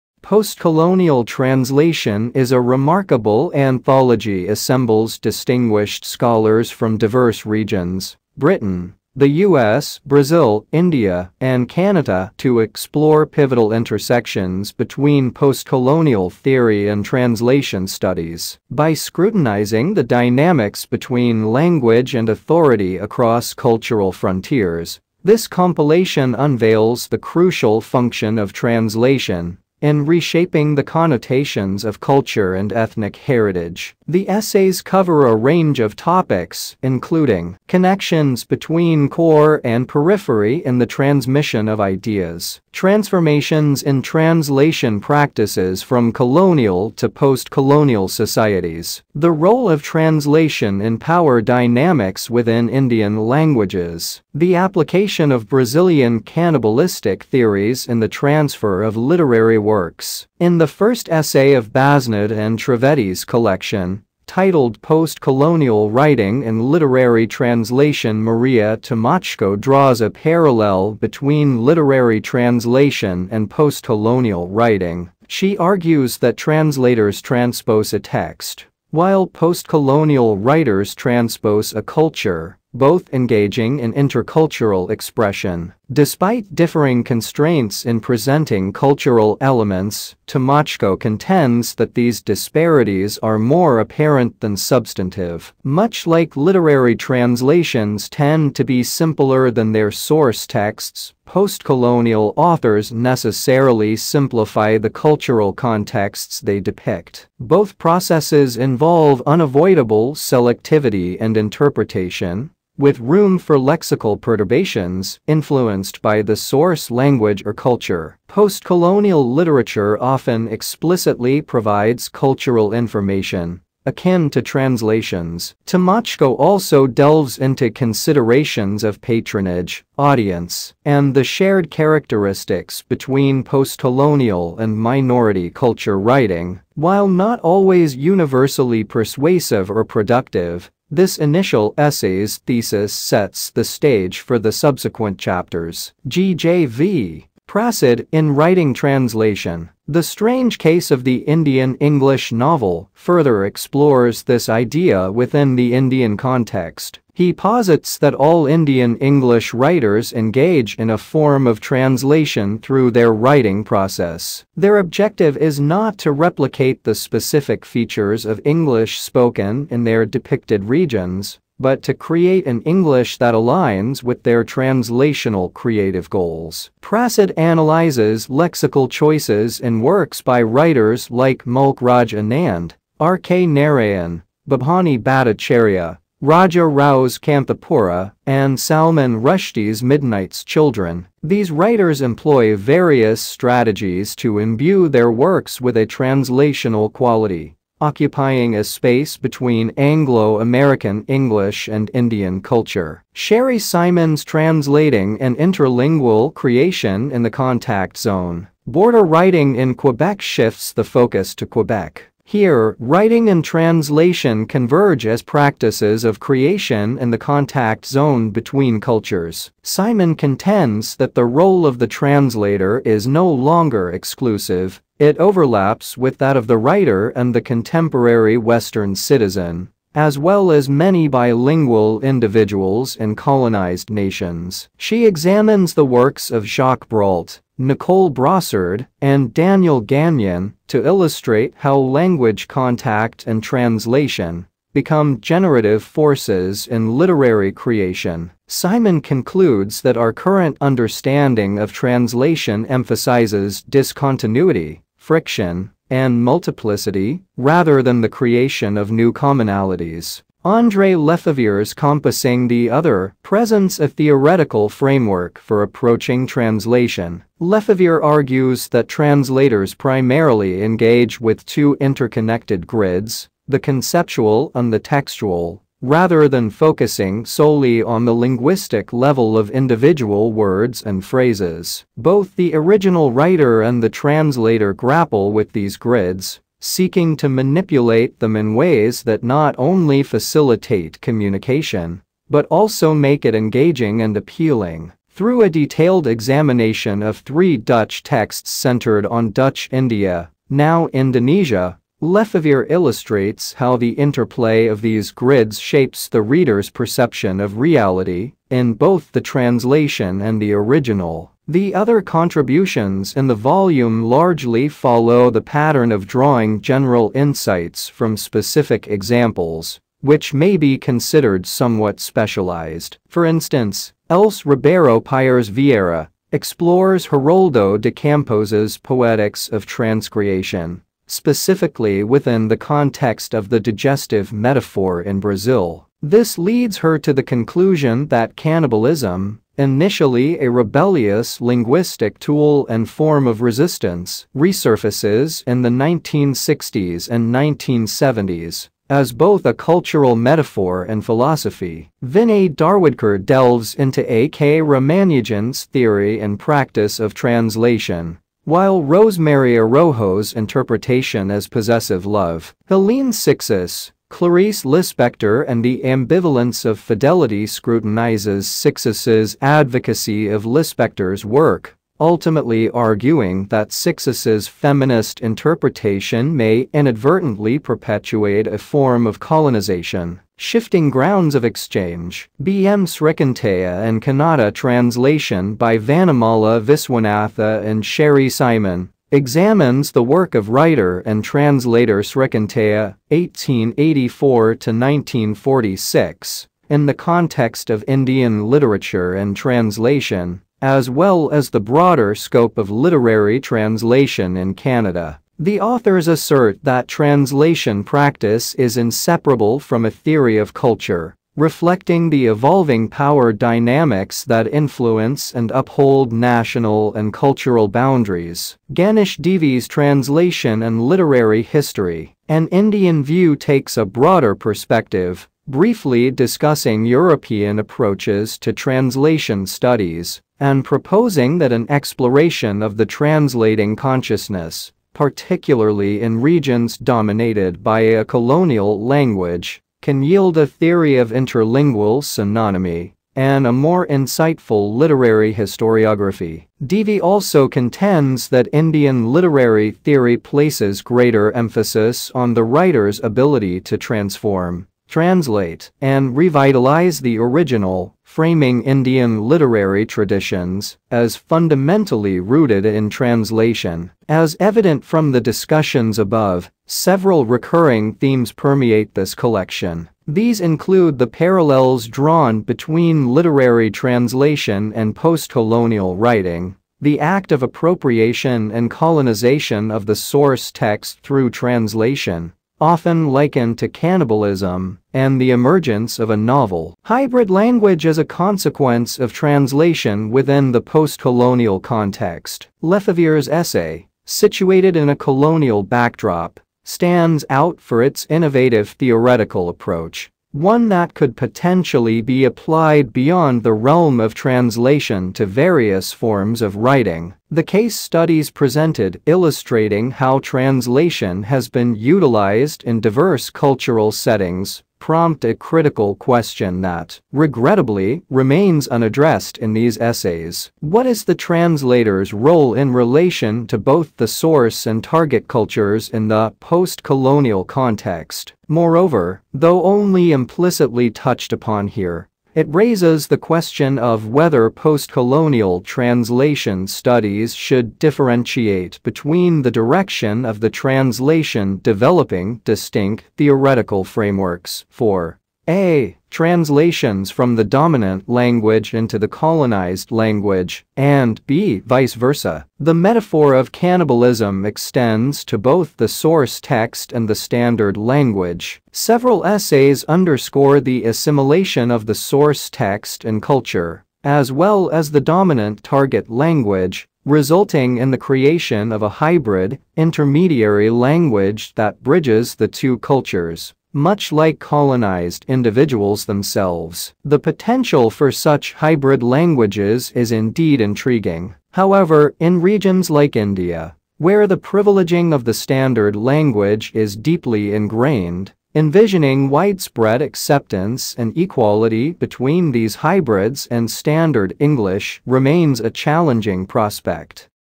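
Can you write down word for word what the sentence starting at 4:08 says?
Simon concludes that our current understanding of translation emphasizes discontinuity friction, and multiplicity, rather than the creation of new commonalities.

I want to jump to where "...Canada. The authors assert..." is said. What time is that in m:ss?
6:44.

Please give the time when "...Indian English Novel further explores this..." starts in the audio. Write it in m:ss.
2:31.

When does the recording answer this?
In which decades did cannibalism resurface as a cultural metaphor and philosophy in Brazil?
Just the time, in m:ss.
5:45.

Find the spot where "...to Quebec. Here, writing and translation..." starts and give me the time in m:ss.
3:31.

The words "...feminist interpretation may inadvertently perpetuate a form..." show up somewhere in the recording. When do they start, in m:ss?
6:14.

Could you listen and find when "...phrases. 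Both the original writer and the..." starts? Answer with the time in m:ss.
4:41.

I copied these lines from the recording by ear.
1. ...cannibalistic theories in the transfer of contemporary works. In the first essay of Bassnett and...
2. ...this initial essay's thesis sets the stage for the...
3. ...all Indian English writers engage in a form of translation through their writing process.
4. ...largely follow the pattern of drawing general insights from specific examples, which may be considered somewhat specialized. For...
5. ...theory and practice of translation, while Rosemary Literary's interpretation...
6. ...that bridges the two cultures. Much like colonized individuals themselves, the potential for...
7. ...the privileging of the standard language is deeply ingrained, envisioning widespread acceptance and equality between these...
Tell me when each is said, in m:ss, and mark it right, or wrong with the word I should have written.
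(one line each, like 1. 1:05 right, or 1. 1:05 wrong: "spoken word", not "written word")
1. 0:56 wrong: "literary", not "contemporary"
2. 2:20 right
3. 2:38 right
4. 5:14 right
5. 5:55 wrong: "Arrojo", not "Literary"
6. 9:31 right
7. 9:44 right.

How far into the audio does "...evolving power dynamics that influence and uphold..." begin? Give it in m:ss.
6:52.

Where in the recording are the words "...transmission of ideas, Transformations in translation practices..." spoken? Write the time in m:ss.
0:40.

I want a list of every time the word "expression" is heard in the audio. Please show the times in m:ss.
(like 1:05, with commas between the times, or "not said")
1:24.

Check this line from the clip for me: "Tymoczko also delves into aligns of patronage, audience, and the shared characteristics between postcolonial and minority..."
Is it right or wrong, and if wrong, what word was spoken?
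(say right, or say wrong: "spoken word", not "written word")
wrong: "considerations", not "aligns".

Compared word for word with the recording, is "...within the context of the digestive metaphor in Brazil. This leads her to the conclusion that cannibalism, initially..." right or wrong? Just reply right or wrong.
right.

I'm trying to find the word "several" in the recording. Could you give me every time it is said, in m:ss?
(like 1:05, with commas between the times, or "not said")
7:46, 9:18.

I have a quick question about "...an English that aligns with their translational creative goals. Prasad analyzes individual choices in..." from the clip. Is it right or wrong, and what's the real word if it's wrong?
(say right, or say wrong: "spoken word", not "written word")
wrong: "lexical", not "individual".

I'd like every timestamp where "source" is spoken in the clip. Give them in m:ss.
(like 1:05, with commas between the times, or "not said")
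1:39, 1:56, 7:59, 8:44, 9:15, 9:21.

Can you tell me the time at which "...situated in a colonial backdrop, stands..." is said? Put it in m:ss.
8:14.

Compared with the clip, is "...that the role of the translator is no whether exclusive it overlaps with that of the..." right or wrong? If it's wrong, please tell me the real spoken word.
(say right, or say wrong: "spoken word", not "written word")
wrong: "longer", not "whether".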